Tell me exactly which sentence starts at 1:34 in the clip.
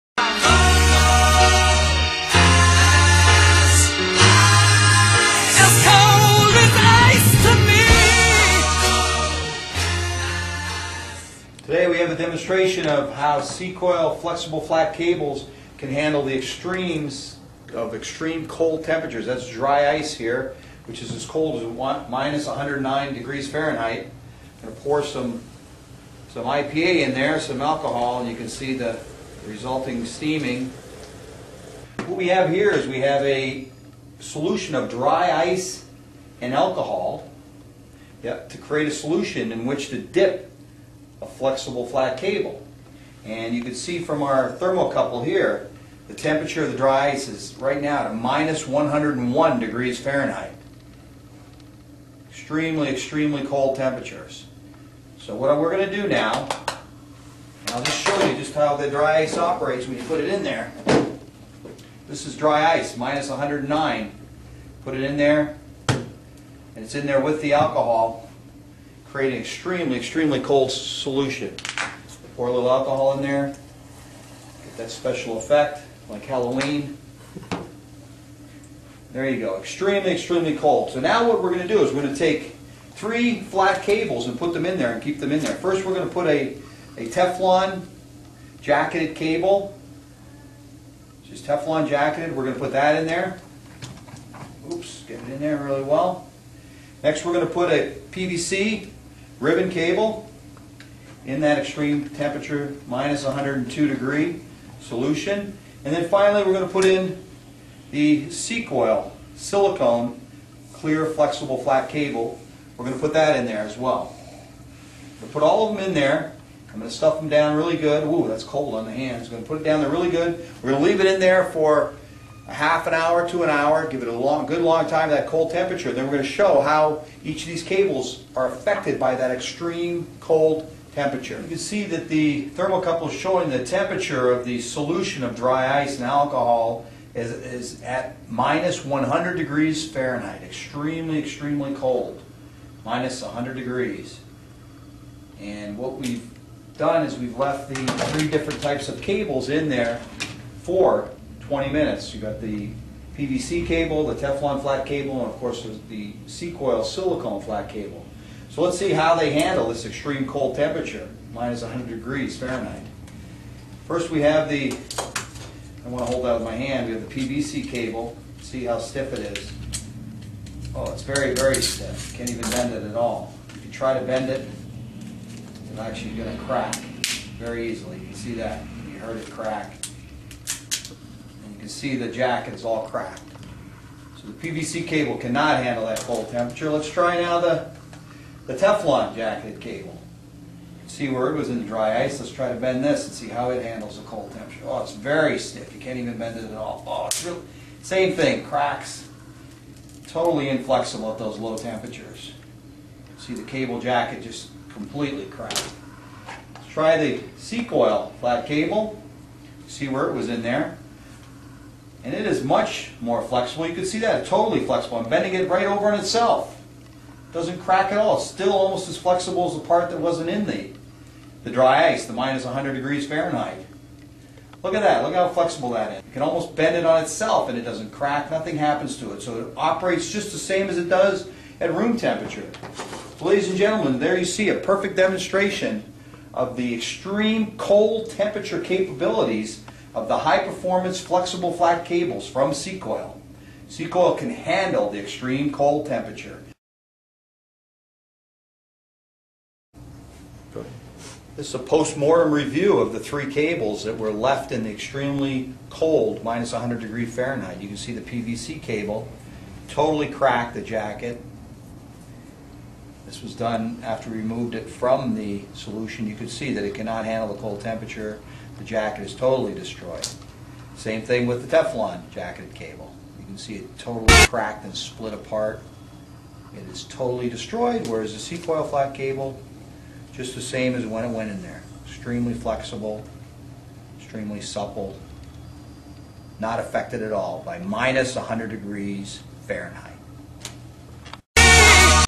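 Oops, get it in there really well.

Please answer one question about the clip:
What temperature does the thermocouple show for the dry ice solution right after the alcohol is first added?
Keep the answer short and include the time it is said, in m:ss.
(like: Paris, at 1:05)
-101°F, at 0:48.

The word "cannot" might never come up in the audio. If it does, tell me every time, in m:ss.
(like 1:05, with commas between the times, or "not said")
3:05, 4:26.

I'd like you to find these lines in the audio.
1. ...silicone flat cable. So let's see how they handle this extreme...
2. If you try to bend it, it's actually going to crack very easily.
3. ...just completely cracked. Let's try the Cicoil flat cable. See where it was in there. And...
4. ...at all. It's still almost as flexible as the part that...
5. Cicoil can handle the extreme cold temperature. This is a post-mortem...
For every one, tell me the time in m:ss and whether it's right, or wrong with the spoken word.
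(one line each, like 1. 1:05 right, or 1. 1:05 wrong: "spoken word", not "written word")
1. 2:36 right
2. 2:53 right
3. 3:24 right
4. 3:37 right
5. 4:03 right.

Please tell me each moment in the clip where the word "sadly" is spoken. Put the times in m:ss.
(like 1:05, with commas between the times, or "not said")
not said.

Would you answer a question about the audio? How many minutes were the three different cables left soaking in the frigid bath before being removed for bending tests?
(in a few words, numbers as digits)
20 minutes.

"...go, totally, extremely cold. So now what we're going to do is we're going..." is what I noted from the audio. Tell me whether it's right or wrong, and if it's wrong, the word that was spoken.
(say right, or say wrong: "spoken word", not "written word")
wrong: "extremely", not "totally".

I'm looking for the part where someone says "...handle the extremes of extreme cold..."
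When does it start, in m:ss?
0:15.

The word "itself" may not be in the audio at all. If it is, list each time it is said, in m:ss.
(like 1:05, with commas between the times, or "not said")
3:35, 3:47.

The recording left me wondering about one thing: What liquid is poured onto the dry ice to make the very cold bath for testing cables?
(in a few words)
IPA.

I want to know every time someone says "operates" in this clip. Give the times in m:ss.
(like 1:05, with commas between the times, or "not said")
0:59, 3:49.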